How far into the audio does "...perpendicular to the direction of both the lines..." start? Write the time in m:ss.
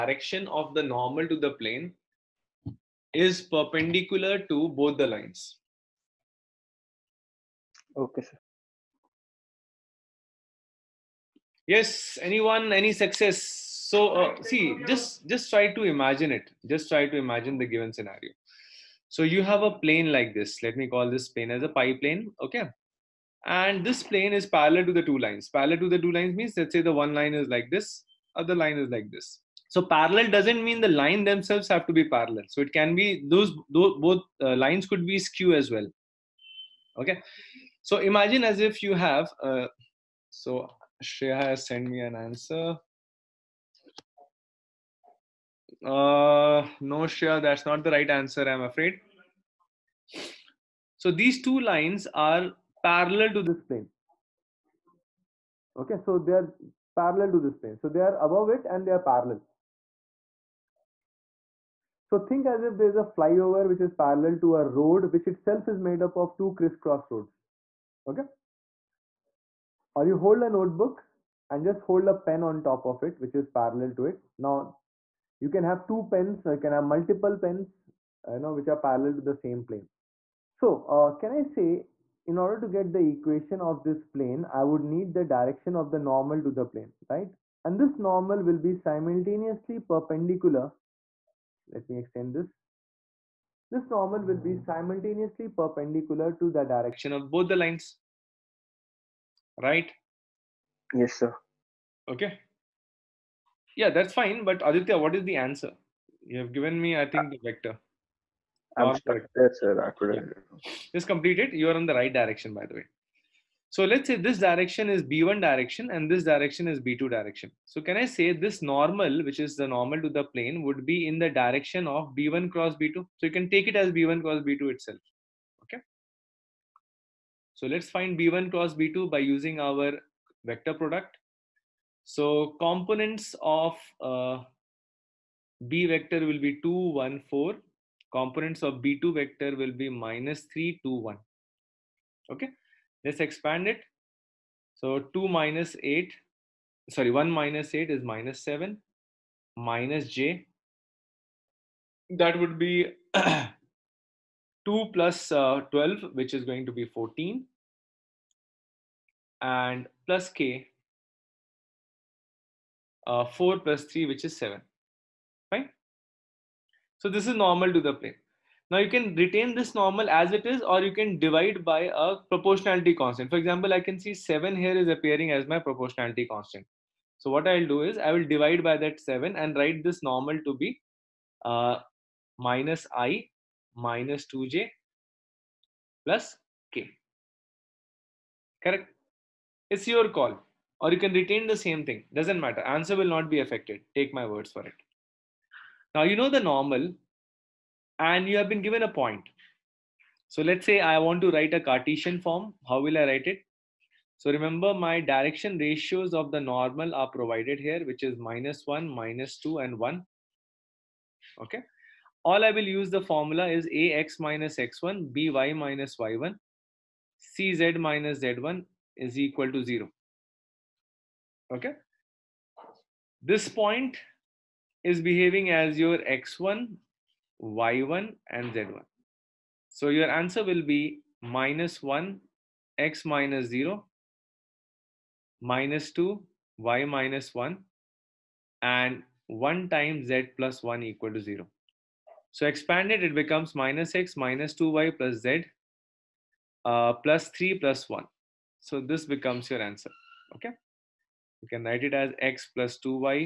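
1:35.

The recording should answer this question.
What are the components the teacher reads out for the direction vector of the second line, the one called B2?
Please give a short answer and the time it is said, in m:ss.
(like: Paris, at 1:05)
-3, 2, 1, at 2:19.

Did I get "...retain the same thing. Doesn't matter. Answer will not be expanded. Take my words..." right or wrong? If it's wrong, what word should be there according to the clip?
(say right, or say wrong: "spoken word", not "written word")
wrong: "affected", not "expanded".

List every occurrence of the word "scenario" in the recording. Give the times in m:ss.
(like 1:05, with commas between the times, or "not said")
0:17.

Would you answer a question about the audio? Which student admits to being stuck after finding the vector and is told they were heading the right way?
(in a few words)
Aditya.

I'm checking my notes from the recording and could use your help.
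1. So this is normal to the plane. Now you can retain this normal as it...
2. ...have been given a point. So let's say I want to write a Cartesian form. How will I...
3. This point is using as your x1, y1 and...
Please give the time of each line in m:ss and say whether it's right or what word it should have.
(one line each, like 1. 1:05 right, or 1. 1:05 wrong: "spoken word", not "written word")
1. 2:46 right
2. 3:18 right
3. 3:43 wrong: "behaving", not "using".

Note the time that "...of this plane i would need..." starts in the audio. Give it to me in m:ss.
1:23.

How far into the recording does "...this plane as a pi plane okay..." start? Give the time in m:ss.
0:21.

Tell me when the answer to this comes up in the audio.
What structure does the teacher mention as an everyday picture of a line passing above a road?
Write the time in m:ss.
1:03.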